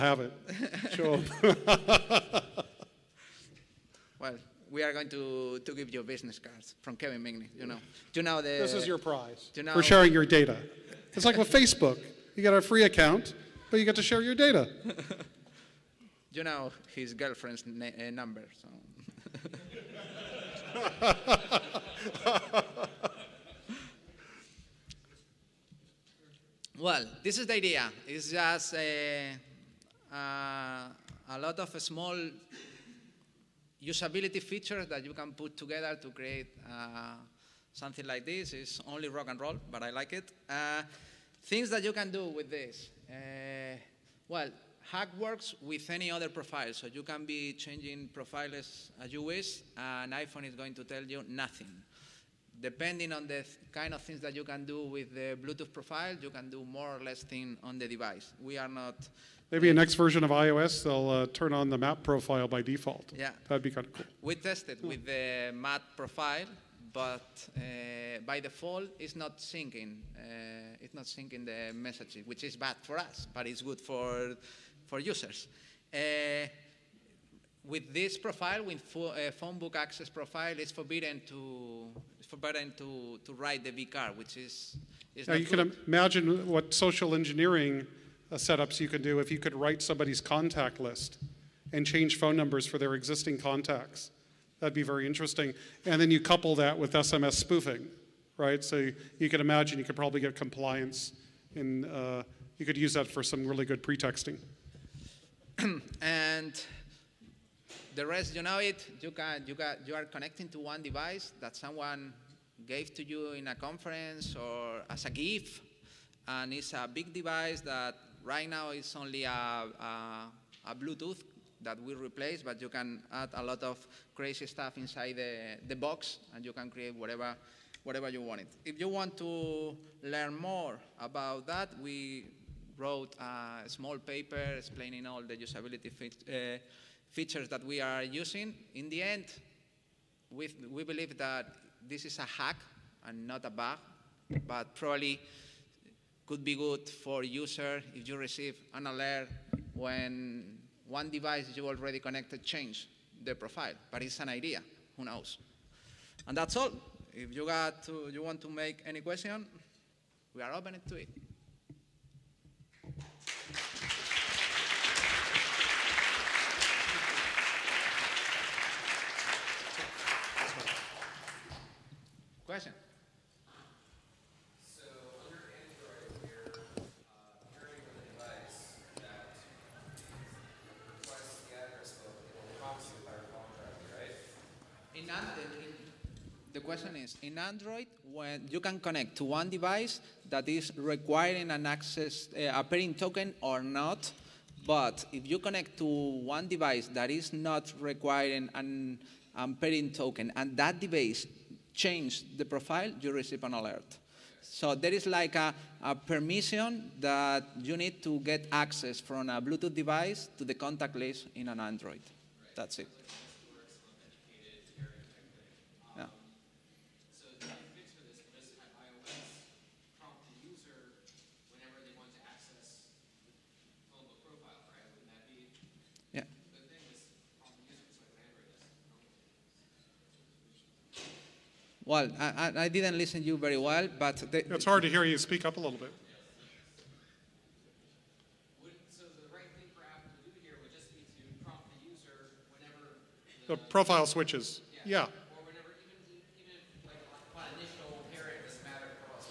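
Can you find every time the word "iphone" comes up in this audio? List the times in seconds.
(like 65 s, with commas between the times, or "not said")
50 s.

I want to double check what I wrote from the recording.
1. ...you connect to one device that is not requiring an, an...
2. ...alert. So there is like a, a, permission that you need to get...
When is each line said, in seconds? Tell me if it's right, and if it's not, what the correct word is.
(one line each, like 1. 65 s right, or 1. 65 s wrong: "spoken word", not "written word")
1. 195 s right
2. 203 s right.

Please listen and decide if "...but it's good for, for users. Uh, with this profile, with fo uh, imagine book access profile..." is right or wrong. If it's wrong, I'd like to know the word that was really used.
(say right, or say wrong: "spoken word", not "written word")
wrong: "phone", not "imagine".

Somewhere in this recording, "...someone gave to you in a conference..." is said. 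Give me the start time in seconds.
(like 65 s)
111 s.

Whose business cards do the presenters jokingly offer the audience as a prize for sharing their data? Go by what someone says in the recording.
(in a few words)
Kevin Migney.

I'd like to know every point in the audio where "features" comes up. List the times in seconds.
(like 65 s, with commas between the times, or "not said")
34 s, 137 s.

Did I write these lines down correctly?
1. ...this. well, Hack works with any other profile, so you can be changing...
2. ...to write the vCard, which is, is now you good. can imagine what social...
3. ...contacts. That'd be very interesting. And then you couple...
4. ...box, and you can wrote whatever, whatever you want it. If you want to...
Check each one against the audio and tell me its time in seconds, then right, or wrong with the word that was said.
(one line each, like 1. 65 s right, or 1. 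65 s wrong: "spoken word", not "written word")
1. 42 s right
2. 83 s right
3. 93 s right
4. 125 s wrong: "create", not "wrote".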